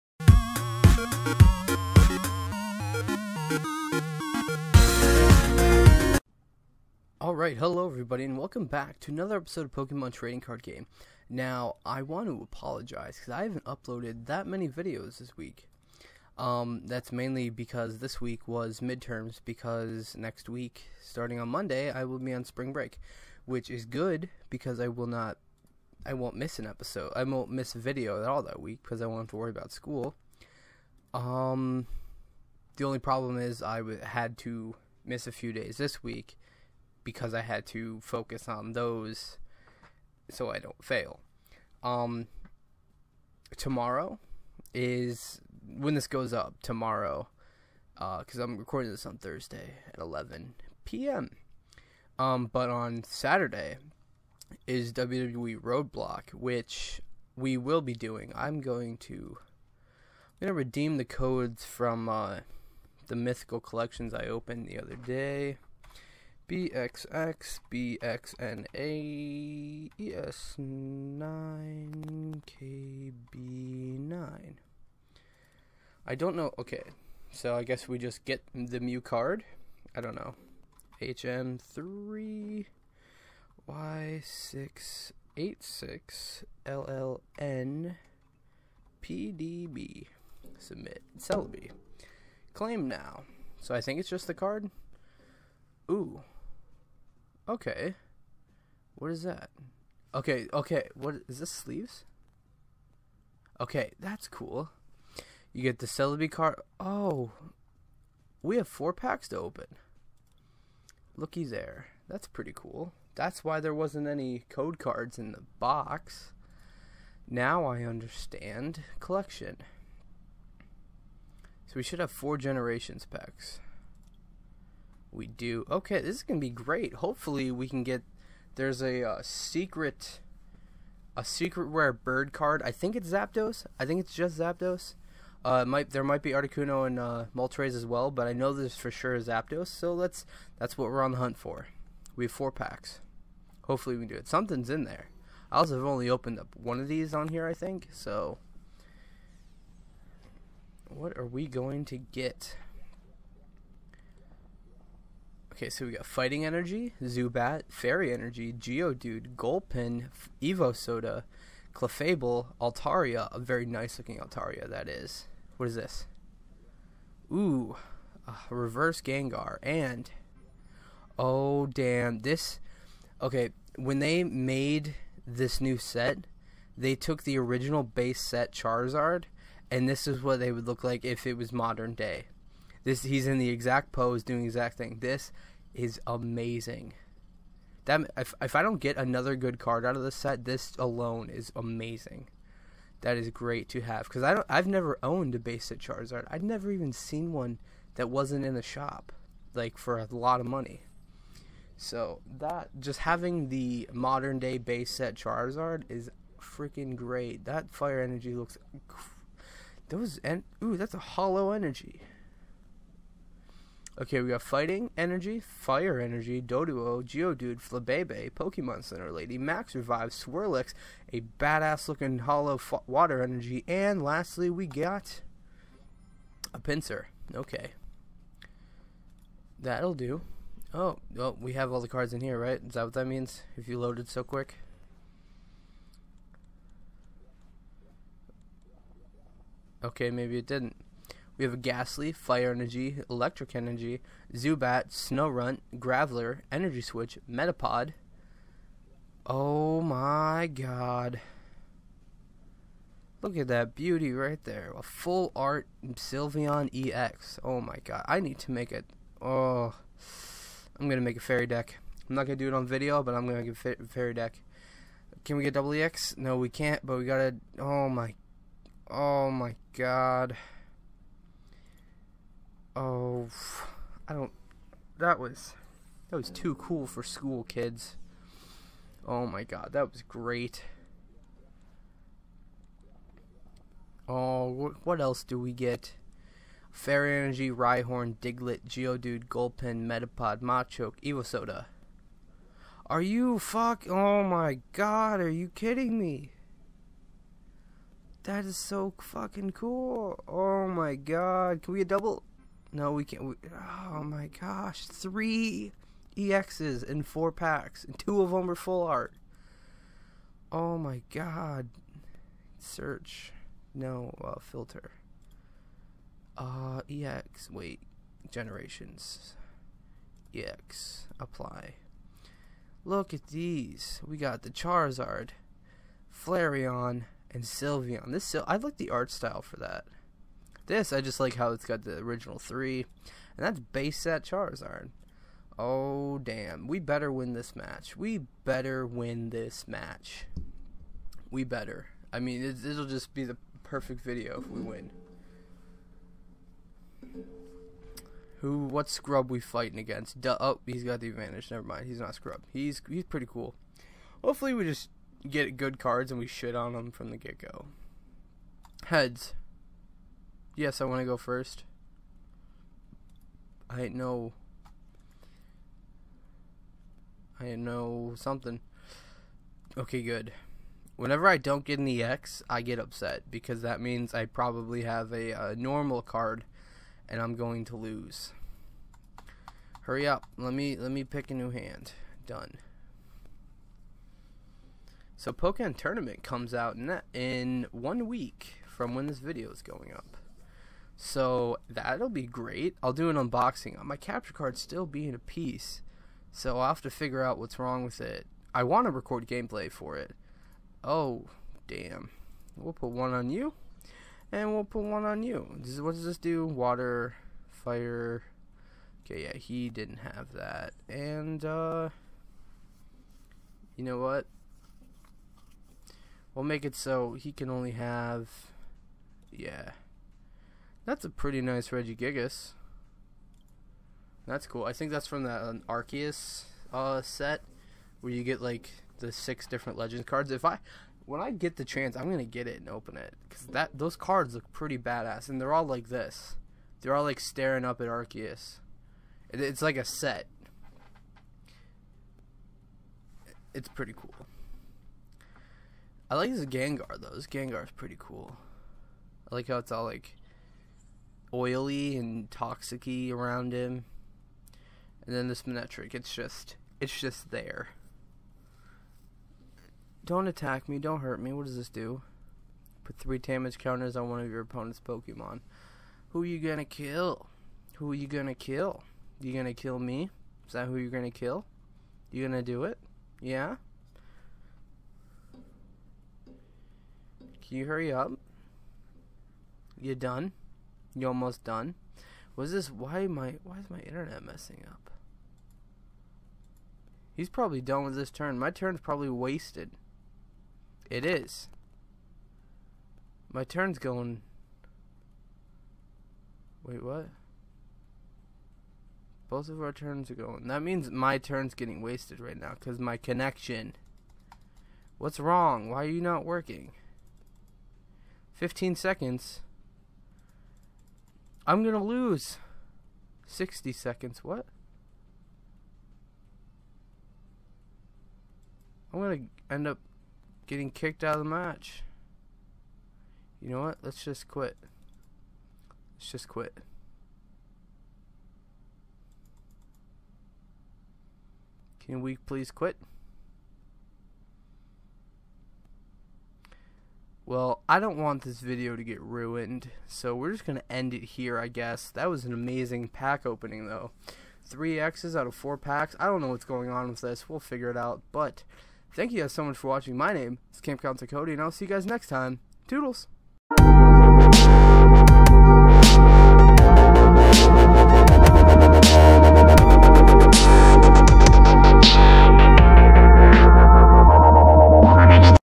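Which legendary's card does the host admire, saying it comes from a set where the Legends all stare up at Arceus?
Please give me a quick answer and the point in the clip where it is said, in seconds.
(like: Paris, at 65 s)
Regigigas, at 421 s.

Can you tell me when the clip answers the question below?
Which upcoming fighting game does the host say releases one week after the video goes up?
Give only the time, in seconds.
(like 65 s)
385 s.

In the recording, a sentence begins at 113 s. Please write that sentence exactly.
That's why there wasn't any code cards in the box.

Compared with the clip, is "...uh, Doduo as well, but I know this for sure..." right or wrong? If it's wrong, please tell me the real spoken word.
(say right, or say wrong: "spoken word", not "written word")
wrong: "Moltres", not "Doduo".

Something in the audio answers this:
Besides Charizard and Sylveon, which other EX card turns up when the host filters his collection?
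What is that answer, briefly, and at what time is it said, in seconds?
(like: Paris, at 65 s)
Flareon, at 326 s.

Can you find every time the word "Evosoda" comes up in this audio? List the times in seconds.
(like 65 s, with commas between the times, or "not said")
160 s, 291 s.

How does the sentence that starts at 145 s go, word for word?
I also have only opened up one of these on here, I think.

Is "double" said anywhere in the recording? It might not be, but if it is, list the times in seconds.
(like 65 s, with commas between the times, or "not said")
265 s, 301 s.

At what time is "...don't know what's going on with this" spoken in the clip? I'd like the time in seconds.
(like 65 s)
546 s.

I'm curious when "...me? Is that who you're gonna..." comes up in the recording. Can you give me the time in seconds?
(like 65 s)
469 s.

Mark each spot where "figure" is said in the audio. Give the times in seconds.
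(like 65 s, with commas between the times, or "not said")
396 s, 547 s.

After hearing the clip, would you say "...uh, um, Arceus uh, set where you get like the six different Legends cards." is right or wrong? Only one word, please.
right.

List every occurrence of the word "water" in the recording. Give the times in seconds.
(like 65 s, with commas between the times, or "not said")
222 s, 406 s.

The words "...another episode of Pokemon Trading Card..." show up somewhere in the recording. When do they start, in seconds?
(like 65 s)
9 s.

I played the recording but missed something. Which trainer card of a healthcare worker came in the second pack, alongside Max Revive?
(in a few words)
Pokemon Center Lady.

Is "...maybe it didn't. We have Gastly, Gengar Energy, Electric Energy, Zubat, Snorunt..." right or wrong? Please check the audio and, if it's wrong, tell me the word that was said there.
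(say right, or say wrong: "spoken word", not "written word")
wrong: "Fire", not "Gengar".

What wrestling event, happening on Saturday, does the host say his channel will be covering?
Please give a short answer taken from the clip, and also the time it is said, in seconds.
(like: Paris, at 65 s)
WWE Roadblock, at 54 s.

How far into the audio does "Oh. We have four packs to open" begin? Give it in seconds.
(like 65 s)
106 s.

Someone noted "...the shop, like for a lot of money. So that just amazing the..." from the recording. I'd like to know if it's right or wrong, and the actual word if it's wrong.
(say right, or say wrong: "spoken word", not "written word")
wrong: "having", not "amazing".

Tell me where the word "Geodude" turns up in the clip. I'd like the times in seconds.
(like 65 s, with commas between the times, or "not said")
158 s, 217 s, 288 s.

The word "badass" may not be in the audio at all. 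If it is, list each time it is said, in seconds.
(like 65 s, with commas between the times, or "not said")
221 s, 434 s.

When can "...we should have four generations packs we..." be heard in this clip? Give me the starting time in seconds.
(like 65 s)
121 s.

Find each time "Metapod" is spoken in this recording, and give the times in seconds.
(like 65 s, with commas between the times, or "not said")
247 s, 289 s.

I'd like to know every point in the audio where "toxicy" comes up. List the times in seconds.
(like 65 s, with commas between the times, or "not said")
452 s.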